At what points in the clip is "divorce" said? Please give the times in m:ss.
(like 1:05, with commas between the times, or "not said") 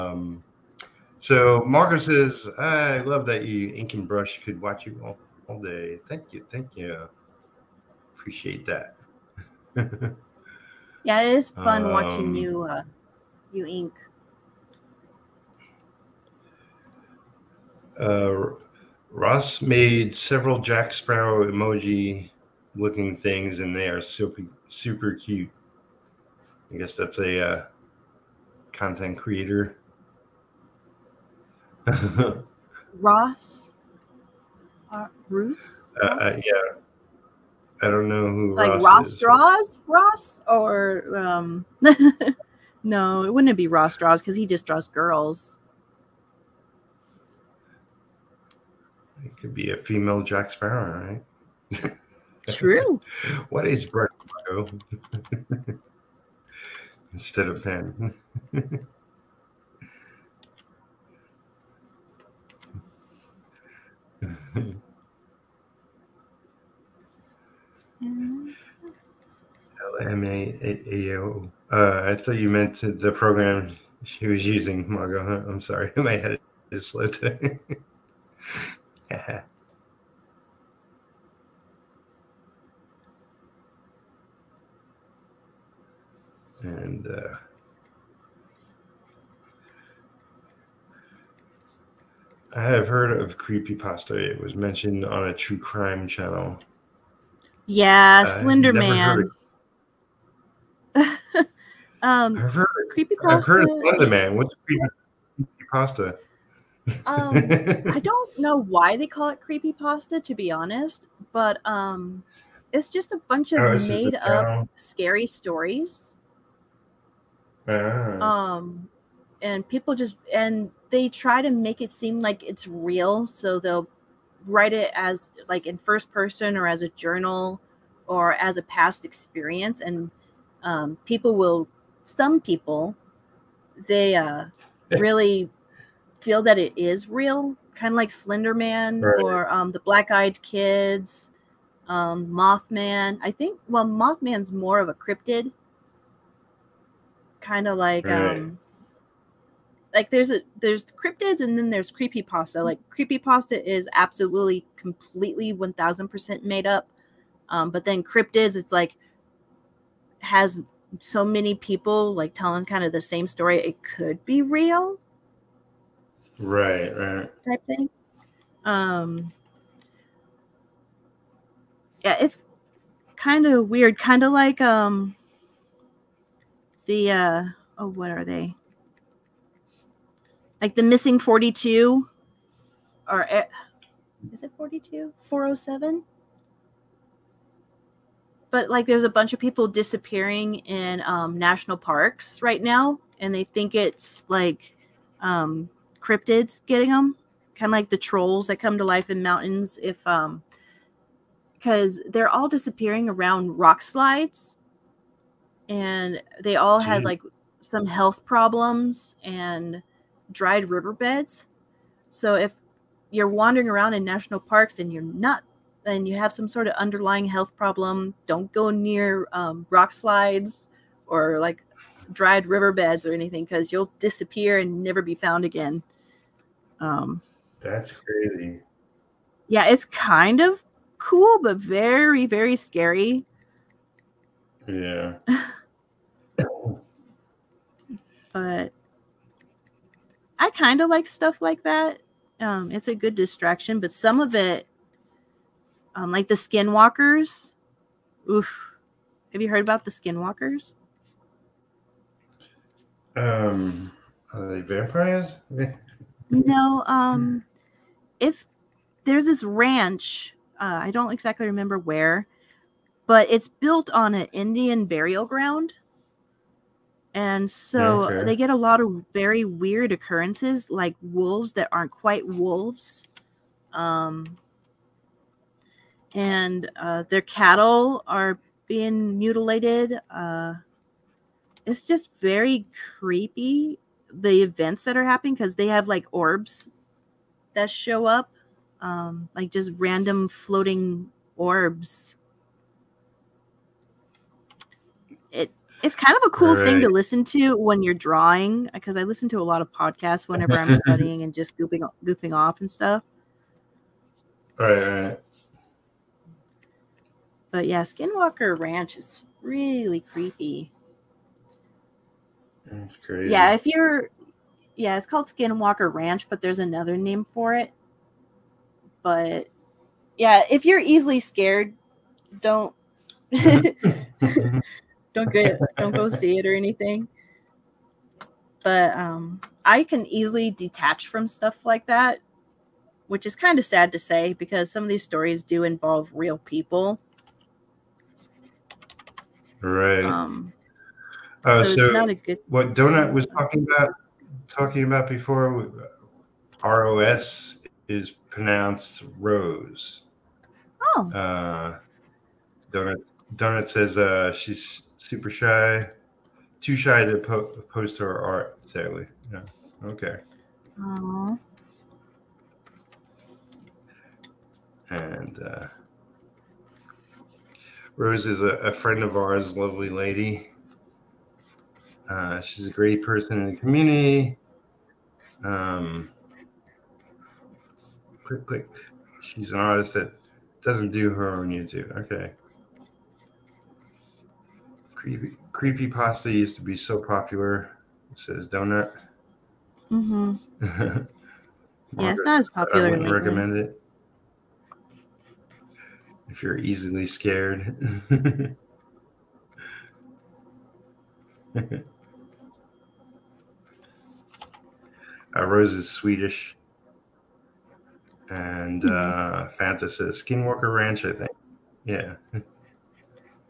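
not said.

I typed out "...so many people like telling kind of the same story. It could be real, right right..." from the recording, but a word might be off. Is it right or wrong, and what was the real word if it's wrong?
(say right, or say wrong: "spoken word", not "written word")
right.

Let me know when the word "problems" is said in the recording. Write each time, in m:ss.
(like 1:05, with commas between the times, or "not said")
3:28, 3:37.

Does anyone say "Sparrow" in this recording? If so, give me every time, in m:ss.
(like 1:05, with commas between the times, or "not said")
0:20, 0:50.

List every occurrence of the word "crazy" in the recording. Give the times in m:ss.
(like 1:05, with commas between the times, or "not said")
3:47, 5:12.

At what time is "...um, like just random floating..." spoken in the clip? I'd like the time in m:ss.
4:48.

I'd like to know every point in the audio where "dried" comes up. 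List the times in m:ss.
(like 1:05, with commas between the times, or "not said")
3:30, 3:42.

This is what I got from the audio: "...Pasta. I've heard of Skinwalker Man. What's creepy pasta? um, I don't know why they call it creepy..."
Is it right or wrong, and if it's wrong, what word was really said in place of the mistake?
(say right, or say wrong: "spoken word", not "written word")
wrong: "Slender", not "Skinwalker".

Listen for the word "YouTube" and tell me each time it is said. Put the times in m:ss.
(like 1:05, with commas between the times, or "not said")
6:21.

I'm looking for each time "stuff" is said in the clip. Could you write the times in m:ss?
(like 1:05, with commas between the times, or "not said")
4:01, 5:02, 5:31.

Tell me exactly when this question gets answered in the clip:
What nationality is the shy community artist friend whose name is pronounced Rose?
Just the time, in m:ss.
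6:45.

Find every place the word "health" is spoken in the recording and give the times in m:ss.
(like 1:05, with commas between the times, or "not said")
3:27, 3:37.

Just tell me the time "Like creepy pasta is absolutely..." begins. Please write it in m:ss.
2:32.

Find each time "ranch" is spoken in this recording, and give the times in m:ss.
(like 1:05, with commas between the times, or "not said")
4:19, 5:08, 5:15, 6:50.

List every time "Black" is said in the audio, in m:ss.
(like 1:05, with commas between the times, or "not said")
2:19.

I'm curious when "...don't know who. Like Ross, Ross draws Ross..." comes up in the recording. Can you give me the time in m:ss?
0:37.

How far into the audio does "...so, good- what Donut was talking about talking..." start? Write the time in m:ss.
5:41.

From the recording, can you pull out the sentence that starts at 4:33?
Um, and uh, their cattle are being mutilated.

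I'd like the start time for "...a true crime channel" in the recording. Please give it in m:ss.
1:35.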